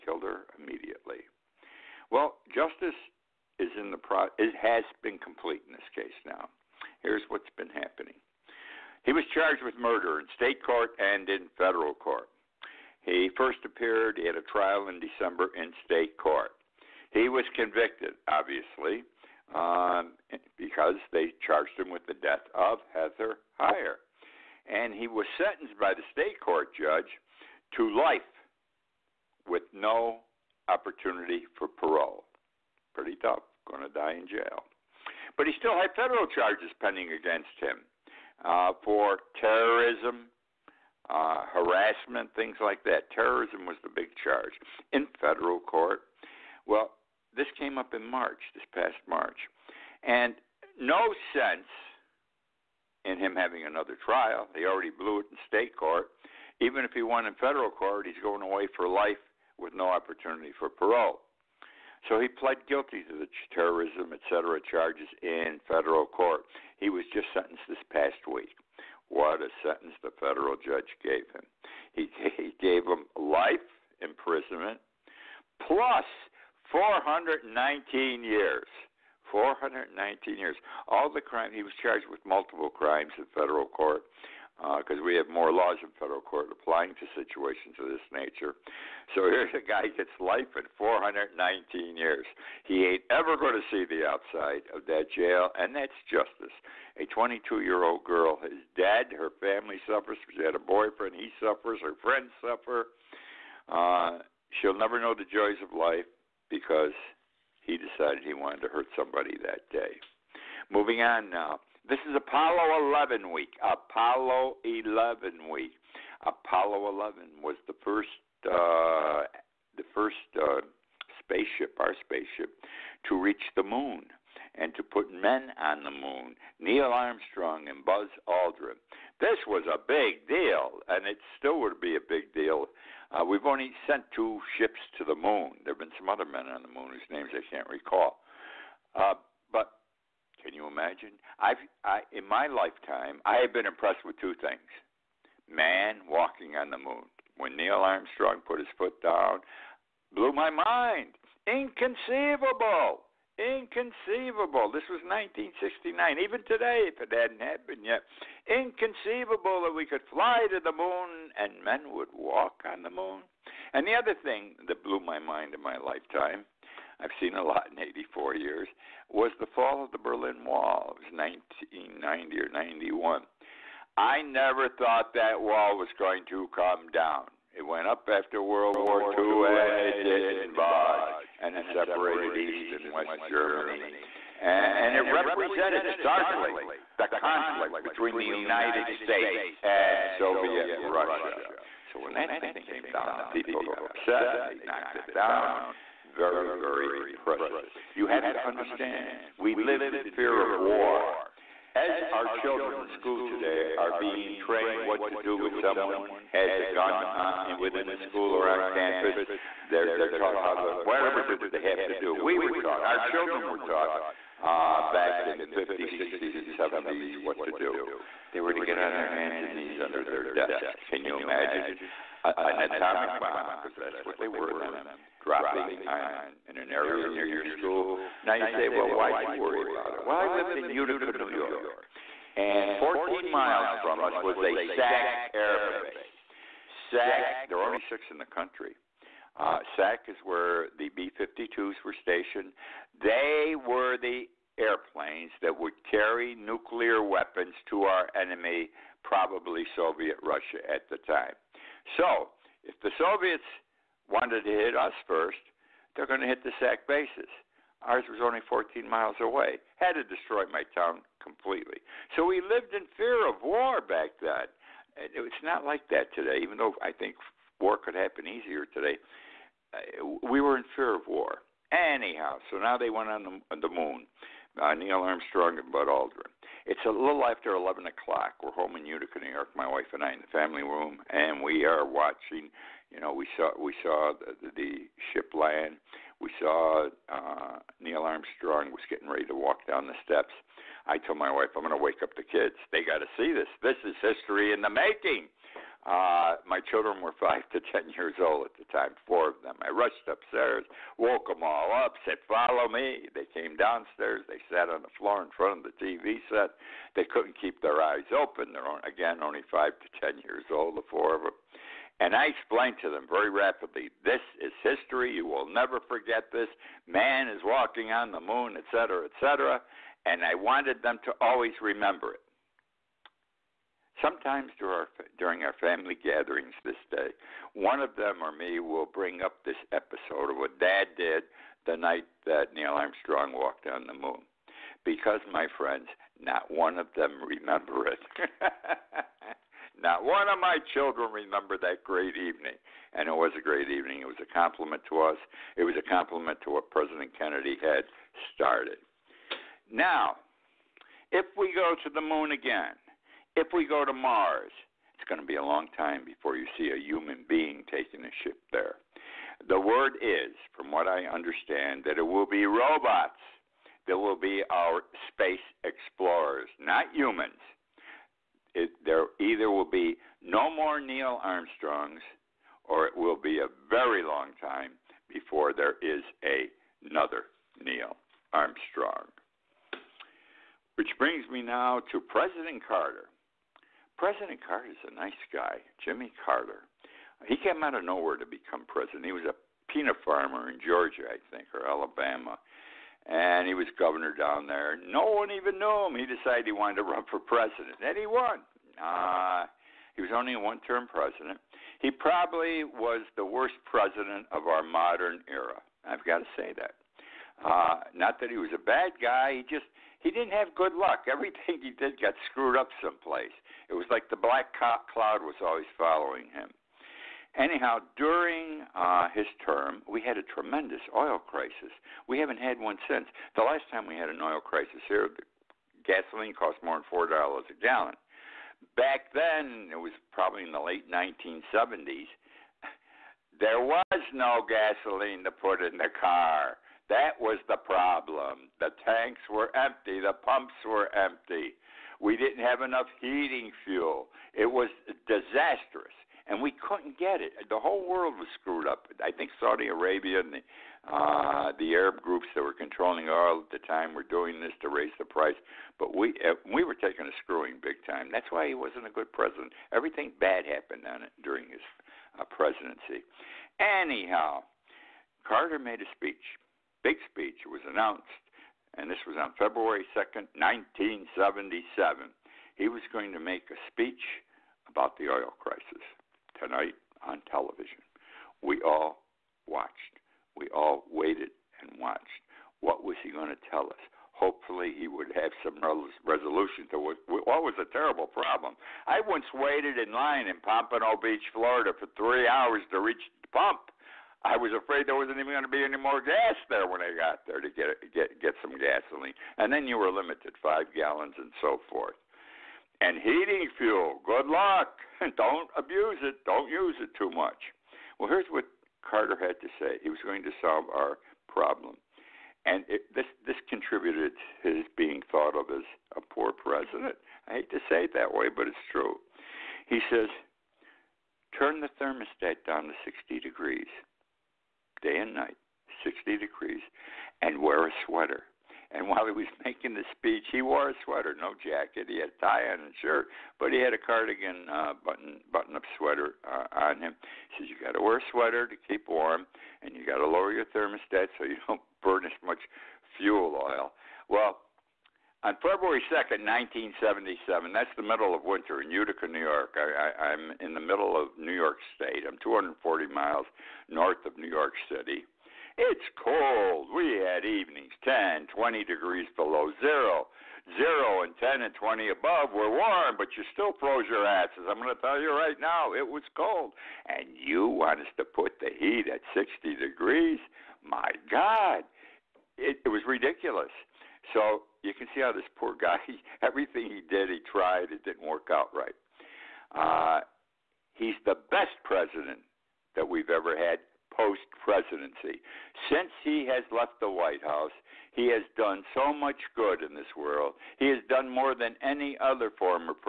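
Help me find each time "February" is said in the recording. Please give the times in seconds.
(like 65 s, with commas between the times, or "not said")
469 s, 545 s.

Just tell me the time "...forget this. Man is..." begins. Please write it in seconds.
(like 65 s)
315 s.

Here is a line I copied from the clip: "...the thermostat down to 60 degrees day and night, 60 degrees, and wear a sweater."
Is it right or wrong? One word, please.
right.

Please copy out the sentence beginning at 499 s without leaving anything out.
And then you were limited five gallons and so forth.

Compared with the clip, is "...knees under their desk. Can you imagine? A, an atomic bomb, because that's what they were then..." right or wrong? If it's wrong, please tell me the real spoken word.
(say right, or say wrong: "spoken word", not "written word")
right.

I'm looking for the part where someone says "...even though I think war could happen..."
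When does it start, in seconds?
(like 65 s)
266 s.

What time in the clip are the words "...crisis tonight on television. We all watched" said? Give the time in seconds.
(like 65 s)
475 s.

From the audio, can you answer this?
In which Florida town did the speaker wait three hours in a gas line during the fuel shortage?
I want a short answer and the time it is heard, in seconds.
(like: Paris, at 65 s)
Pompano Beach, at 490 s.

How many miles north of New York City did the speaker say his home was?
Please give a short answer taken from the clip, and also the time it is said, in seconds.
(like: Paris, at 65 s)
240, at 552 s.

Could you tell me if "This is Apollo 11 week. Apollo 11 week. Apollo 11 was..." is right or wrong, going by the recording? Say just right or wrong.
right.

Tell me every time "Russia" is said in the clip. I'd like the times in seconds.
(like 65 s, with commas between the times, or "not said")
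190 s, 250 s.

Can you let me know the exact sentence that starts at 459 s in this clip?
Everything bad happened on it during his uh, presidency.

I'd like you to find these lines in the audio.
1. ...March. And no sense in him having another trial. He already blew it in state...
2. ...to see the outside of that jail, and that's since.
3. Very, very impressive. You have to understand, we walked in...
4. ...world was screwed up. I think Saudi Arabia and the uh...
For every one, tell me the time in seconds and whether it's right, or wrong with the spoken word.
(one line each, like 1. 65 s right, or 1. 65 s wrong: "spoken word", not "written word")
1. 49 s right
2. 93 s wrong: "justice", not "since"
3. 196 s wrong: "lived", not "walked"
4. 447 s right.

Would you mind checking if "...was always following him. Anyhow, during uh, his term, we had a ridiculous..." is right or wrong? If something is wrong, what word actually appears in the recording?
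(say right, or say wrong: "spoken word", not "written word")
wrong: "tremendous", not "ridiculous".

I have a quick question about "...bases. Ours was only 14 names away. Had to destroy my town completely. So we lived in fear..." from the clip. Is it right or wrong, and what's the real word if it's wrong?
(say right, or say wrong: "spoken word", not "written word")
wrong: "miles", not "names".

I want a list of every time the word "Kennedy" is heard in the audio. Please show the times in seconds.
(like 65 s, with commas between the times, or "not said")
347 s.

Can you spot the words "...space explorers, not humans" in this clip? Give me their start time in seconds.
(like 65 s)
365 s.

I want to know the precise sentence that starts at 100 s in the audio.
She had a boyfriend, he suffers.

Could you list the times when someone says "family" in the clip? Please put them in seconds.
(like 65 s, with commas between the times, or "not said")
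99 s, 280 s, 325 s.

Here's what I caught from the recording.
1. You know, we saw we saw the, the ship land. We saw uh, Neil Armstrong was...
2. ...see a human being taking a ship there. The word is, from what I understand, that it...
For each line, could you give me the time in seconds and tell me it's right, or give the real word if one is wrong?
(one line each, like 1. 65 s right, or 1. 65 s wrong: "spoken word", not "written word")
1. 282 s right
2. 356 s right.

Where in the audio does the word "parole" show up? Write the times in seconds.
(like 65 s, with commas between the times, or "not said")
31 s, 60 s.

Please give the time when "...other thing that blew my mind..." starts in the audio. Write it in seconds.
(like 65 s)
163 s.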